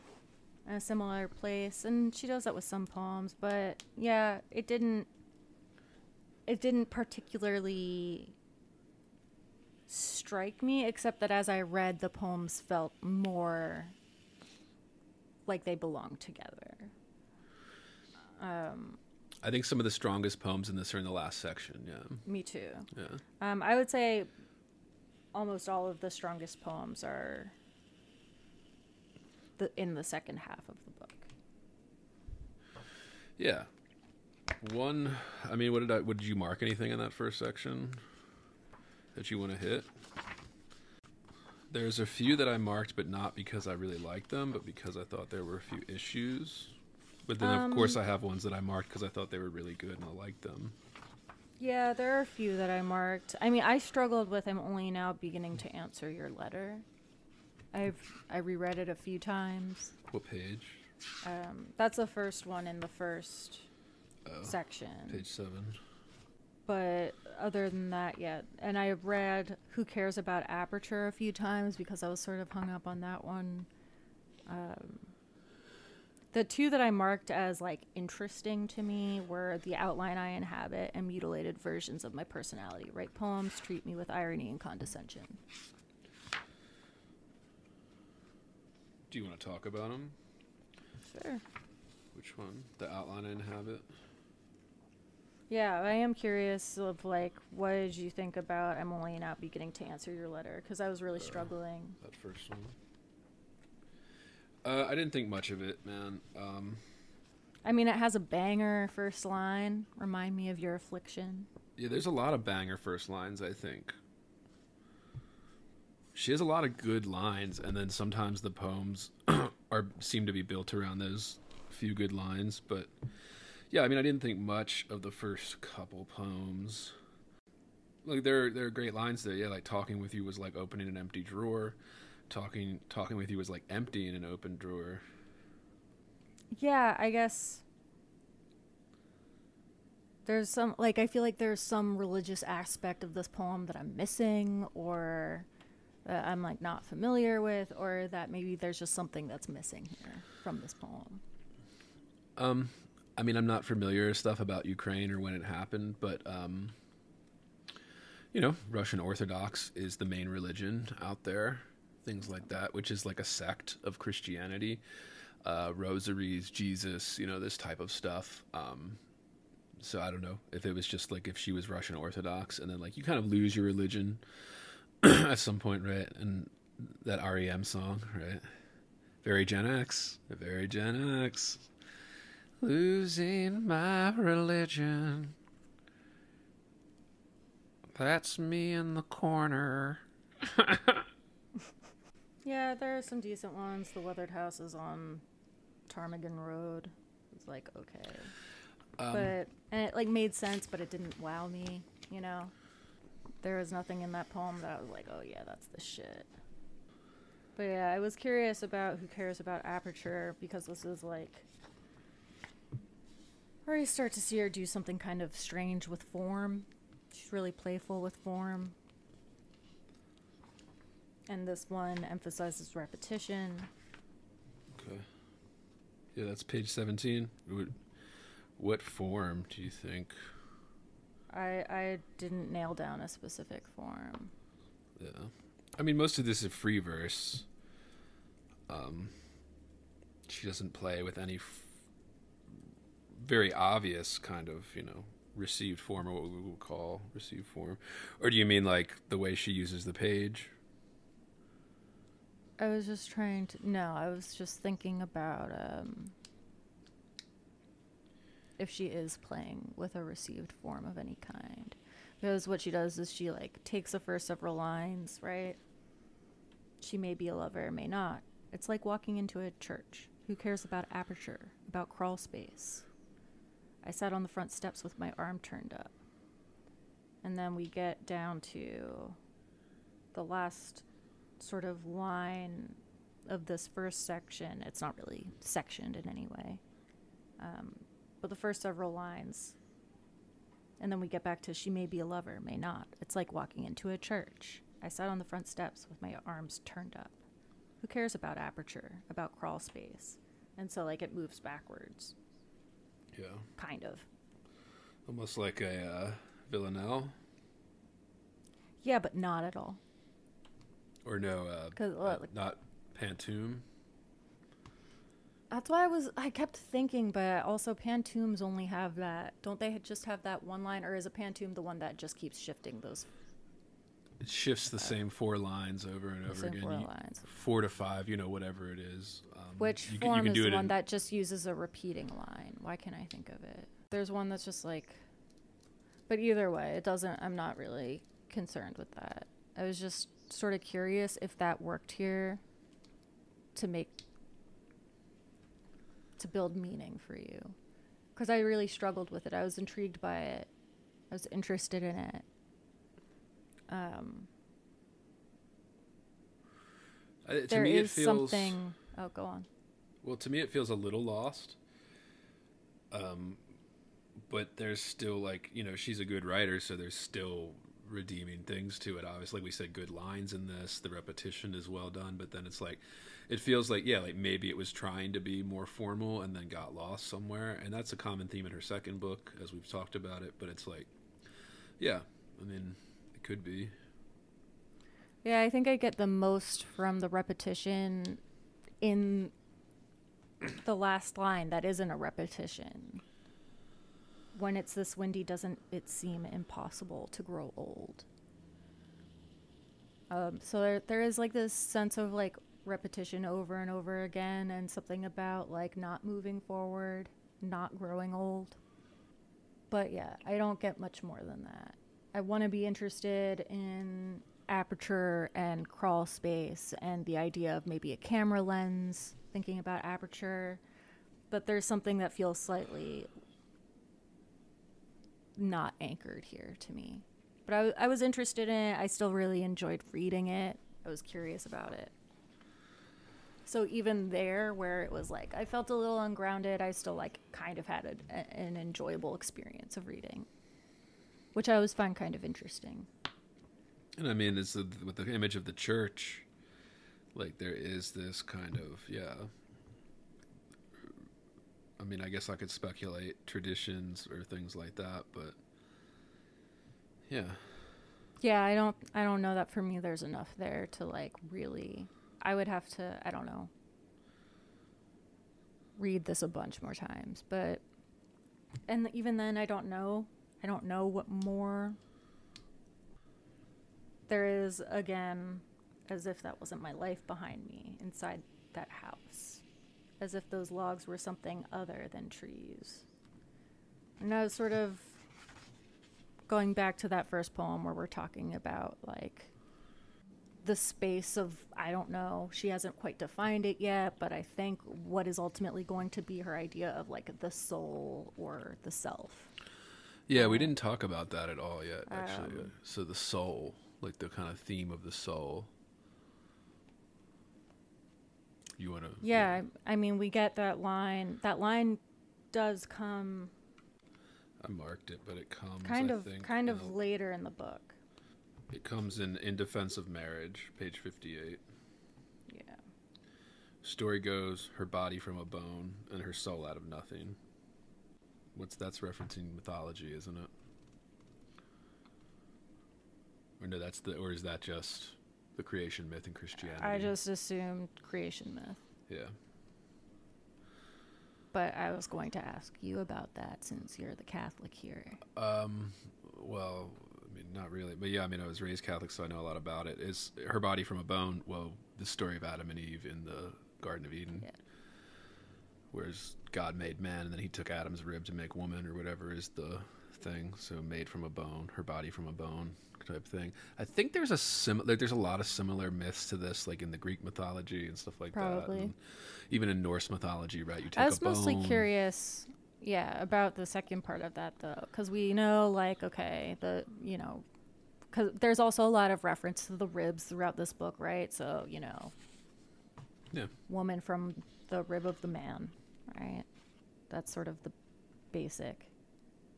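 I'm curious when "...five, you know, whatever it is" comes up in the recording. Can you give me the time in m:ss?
5:27.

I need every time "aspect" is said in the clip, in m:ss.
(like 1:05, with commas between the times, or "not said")
2:22.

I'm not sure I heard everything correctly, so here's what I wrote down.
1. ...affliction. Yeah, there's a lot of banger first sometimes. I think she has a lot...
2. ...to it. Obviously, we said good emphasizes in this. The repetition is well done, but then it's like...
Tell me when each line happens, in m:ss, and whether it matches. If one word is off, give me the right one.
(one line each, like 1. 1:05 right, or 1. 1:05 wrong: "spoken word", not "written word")
1. 1:50 wrong: "lines", not "sometimes"
2. 6:08 wrong: "lines", not "emphasizes".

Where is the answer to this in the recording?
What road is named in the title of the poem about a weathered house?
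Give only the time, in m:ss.
3:15.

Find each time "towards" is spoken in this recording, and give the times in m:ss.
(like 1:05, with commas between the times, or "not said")
not said.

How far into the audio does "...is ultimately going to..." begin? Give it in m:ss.
8:15.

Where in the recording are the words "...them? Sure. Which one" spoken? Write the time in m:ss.
1:29.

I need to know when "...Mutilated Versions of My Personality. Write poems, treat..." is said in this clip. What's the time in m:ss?
1:21.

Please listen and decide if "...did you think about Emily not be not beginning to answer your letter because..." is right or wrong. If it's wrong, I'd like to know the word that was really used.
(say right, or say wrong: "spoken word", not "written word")
right.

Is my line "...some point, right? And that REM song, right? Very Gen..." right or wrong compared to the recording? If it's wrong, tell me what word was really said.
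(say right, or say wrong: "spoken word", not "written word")
right.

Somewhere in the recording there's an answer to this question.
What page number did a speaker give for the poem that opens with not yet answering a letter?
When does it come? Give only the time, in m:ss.
1:05.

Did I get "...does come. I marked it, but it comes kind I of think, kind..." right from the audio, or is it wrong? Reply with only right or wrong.
right.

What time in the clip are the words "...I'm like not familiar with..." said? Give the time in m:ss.
2:26.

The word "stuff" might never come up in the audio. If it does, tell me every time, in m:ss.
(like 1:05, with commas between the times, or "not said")
2:34, 2:47, 9:27.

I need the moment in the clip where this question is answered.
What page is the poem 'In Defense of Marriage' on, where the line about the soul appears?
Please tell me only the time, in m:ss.
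8:40.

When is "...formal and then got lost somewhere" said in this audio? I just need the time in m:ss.
6:15.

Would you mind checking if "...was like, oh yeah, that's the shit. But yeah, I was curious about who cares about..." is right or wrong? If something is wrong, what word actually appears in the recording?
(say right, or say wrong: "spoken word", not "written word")
right.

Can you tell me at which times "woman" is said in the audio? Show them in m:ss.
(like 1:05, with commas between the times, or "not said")
9:18, 9:43.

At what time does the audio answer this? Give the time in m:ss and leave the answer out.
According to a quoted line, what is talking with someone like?
2:10.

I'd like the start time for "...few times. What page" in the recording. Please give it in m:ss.
0:58.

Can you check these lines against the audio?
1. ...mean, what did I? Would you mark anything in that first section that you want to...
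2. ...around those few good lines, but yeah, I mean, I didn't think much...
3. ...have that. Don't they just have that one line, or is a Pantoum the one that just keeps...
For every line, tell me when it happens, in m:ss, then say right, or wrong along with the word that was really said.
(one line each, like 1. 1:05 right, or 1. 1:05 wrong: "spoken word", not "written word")
1. 0:35 right
2. 2:00 right
3. 5:18 right.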